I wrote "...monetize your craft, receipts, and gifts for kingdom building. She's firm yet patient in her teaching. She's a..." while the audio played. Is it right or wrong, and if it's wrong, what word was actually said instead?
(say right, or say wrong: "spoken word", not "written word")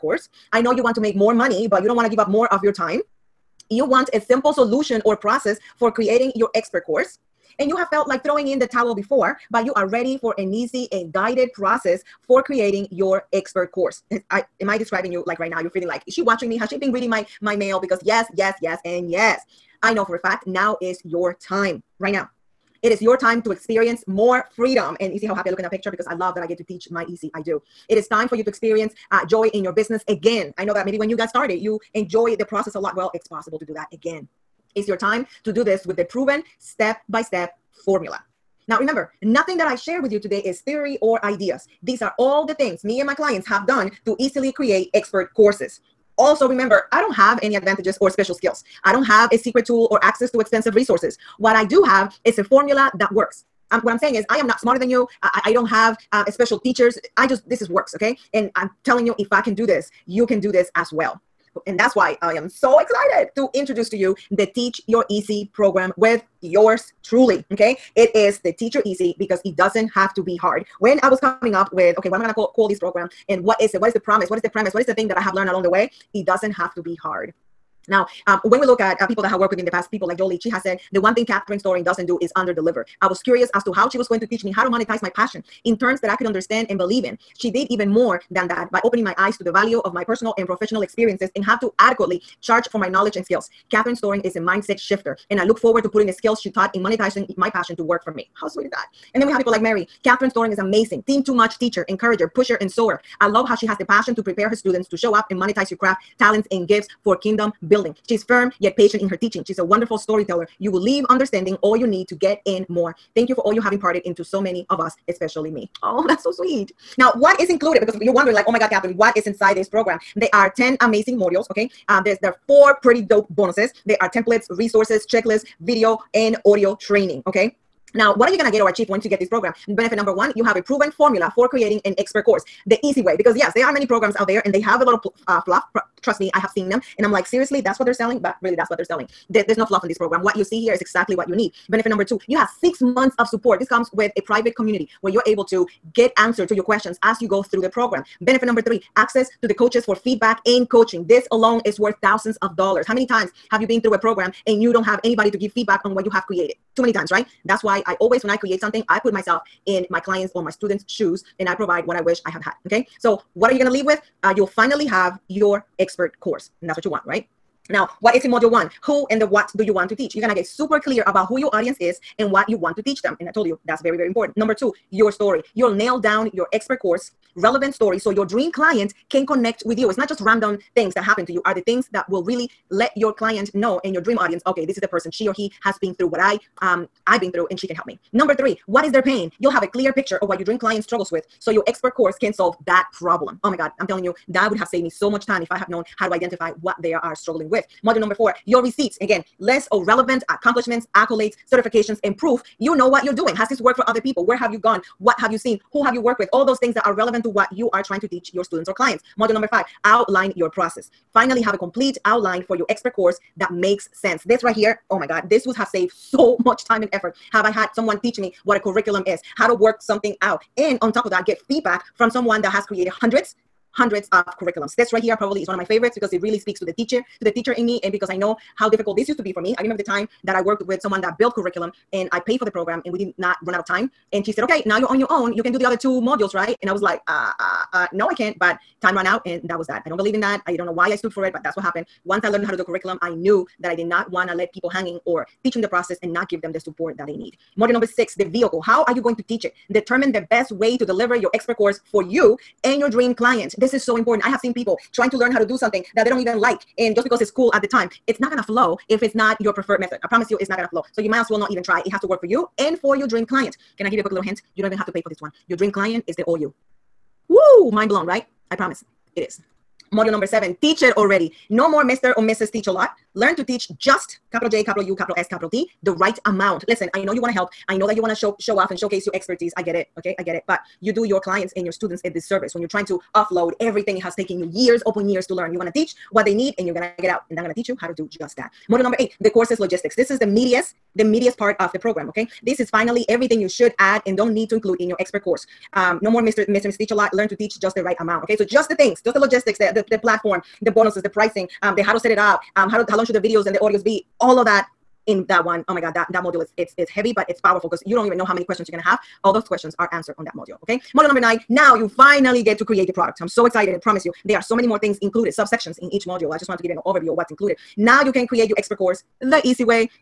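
wrong: "talents", not "receipts".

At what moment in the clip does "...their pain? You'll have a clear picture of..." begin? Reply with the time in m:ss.
3:08.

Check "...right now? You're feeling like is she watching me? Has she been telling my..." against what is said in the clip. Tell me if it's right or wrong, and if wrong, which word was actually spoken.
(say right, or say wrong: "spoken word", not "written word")
wrong: "reading", not "telling".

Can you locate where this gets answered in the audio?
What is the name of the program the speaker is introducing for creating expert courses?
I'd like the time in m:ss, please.
1:04.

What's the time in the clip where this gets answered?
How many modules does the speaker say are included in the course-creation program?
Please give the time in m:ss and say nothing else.
2:00.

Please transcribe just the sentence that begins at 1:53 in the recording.
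Thank you for all you have imparted into so many of us, especially me.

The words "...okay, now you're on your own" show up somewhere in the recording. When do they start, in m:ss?
3:54.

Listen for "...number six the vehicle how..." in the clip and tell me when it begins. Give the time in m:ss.
4:07.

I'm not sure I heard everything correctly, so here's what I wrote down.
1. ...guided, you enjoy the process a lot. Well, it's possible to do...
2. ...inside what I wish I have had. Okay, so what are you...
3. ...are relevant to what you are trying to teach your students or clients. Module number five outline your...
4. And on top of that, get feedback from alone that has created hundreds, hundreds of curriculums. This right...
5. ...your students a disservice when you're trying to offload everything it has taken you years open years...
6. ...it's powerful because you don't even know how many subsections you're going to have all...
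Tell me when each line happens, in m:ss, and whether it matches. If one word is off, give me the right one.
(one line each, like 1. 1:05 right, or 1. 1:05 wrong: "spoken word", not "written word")
1. 0:31 wrong: "started", not "guided"
2. 2:41 wrong: "provide", not "inside"
3. 3:26 right
4. 3:40 wrong: "someone", not "alone"
5. 4:41 right
6. 5:07 wrong: "questions", not "subsections".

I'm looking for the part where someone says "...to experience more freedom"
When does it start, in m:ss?
0:23.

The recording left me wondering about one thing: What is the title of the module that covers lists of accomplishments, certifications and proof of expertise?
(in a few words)
Your receipts.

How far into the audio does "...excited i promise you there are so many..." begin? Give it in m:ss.
5:13.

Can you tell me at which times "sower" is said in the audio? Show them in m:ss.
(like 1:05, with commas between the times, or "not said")
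1:42.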